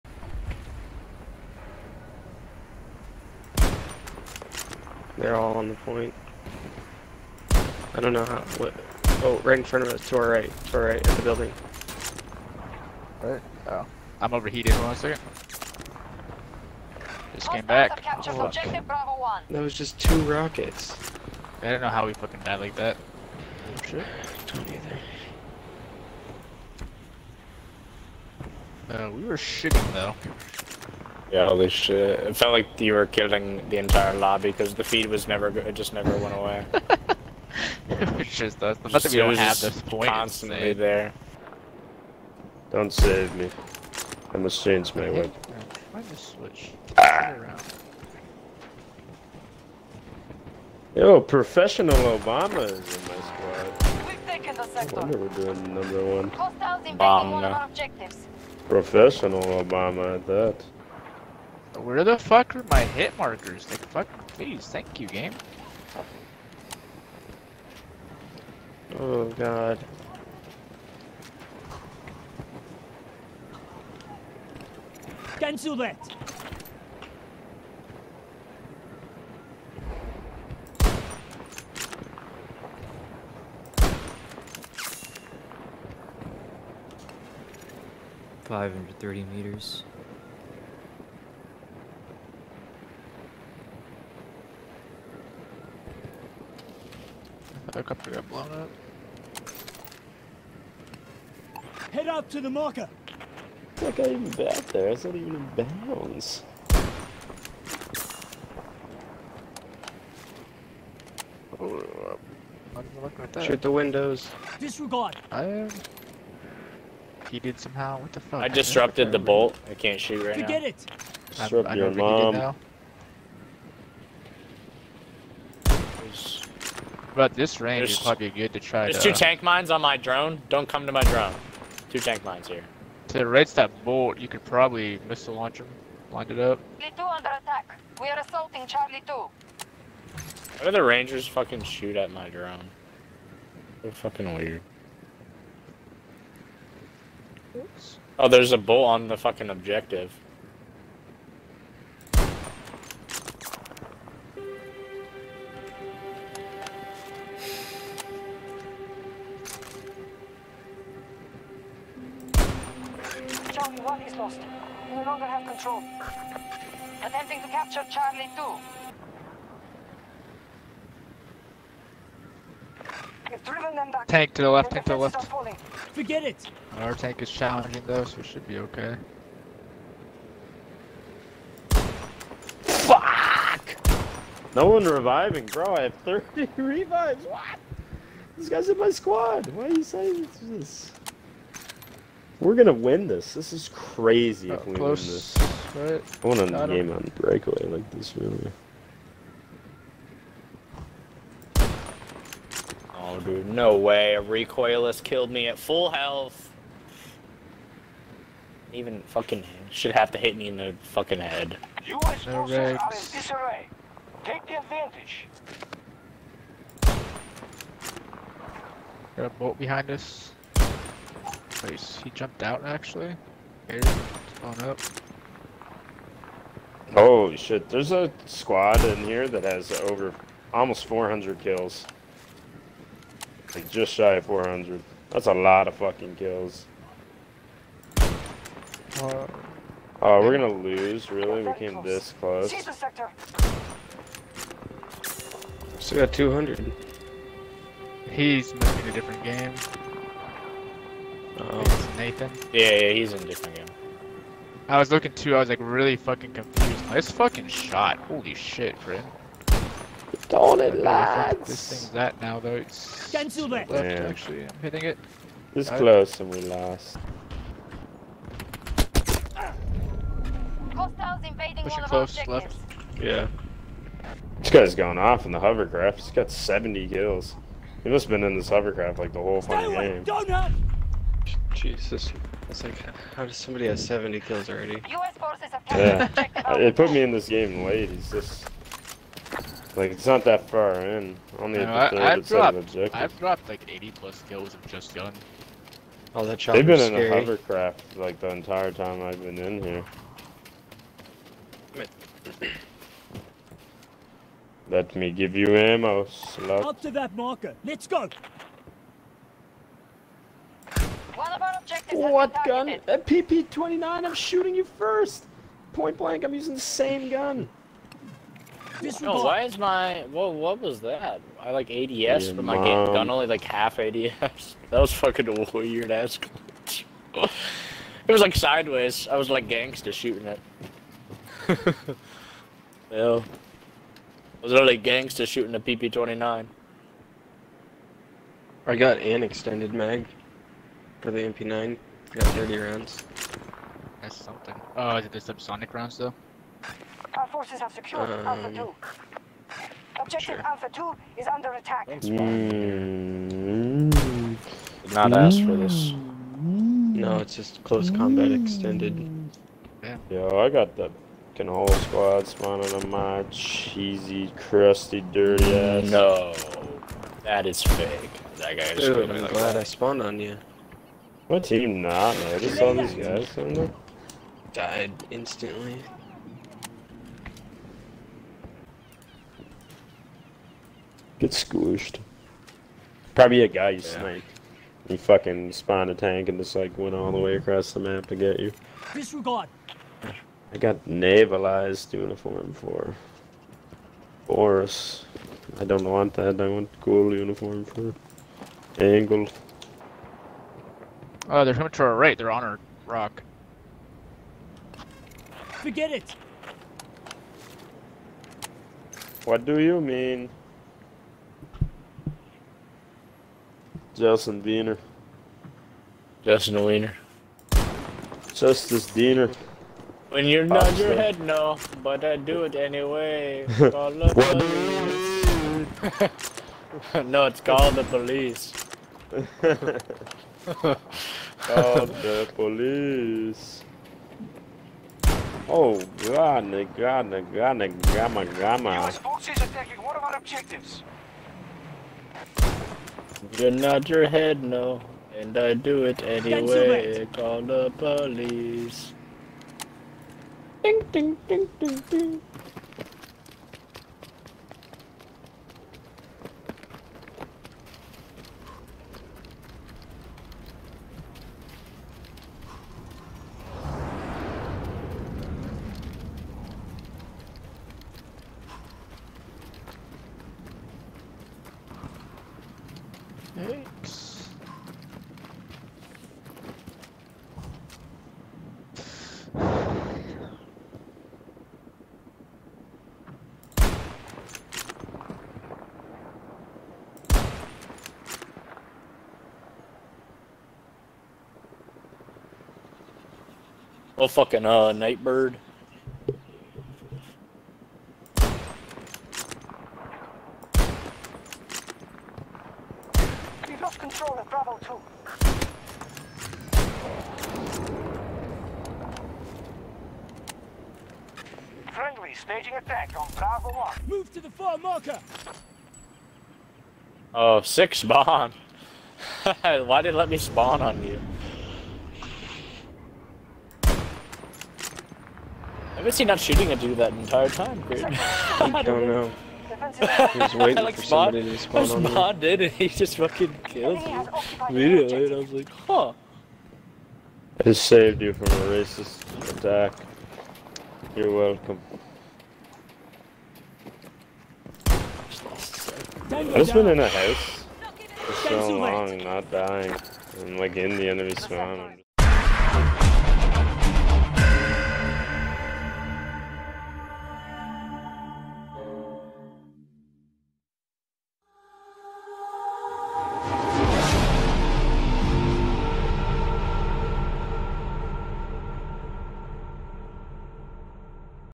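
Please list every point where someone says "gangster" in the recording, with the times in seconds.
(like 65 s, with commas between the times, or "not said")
329 s, 334 s.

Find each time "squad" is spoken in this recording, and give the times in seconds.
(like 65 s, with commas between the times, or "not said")
53 s, 188 s, 228 s, 361 s.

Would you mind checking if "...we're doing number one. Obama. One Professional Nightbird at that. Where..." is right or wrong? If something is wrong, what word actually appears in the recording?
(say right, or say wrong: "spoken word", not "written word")
wrong: "Obama", not "Nightbird".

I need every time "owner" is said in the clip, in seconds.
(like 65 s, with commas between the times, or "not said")
not said.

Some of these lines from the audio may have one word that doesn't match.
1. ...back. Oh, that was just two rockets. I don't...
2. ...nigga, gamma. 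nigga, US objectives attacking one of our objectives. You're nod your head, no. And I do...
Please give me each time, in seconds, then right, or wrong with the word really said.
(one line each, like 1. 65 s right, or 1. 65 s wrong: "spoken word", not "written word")
1. 17 s right
2. 437 s wrong: "forces", not "objectives".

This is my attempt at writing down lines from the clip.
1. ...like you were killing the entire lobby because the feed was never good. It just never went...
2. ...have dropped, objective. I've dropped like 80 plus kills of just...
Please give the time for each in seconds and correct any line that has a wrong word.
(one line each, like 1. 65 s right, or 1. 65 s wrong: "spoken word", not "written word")
1. 32 s right
2. 292 s right.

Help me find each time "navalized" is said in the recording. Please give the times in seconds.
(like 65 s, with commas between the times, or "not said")
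390 s.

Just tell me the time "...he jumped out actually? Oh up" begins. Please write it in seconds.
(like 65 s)
222 s.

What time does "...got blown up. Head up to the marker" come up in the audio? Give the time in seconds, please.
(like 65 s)
98 s.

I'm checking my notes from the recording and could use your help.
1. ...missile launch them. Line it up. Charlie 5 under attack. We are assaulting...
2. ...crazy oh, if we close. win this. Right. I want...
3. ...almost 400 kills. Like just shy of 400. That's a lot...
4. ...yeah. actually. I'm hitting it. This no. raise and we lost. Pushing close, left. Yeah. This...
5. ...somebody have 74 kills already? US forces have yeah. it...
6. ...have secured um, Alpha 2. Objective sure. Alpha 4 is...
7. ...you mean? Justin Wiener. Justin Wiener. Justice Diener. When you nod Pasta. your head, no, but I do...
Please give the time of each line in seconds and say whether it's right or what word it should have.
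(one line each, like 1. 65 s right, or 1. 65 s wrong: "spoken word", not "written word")
1. 135 s wrong: "2", not "5"
2. 193 s right
3. 230 s right
4. 263 s wrong: "close", not "raise"
5. 283 s wrong: "70", not "74"
6. 347 s wrong: "2", not "4"
7. 409 s right.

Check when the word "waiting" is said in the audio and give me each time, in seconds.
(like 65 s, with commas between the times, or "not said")
530 s.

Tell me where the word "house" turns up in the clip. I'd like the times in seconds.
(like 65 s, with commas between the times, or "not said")
546 s.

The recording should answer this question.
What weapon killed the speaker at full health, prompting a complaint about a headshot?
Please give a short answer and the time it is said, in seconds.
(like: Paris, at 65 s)
Recoilless, at 204 s.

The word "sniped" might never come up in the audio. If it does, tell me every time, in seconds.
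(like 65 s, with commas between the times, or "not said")
384 s.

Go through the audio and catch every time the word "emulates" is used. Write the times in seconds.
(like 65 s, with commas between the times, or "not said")
not said.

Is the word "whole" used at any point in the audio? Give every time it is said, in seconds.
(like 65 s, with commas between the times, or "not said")
279 s, 361 s.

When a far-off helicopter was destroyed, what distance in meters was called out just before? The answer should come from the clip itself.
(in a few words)
530.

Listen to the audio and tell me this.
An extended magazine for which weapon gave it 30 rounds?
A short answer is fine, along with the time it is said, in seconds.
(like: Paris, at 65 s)
MP9, at 341 s.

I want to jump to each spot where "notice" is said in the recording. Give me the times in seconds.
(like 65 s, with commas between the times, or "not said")
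372 s.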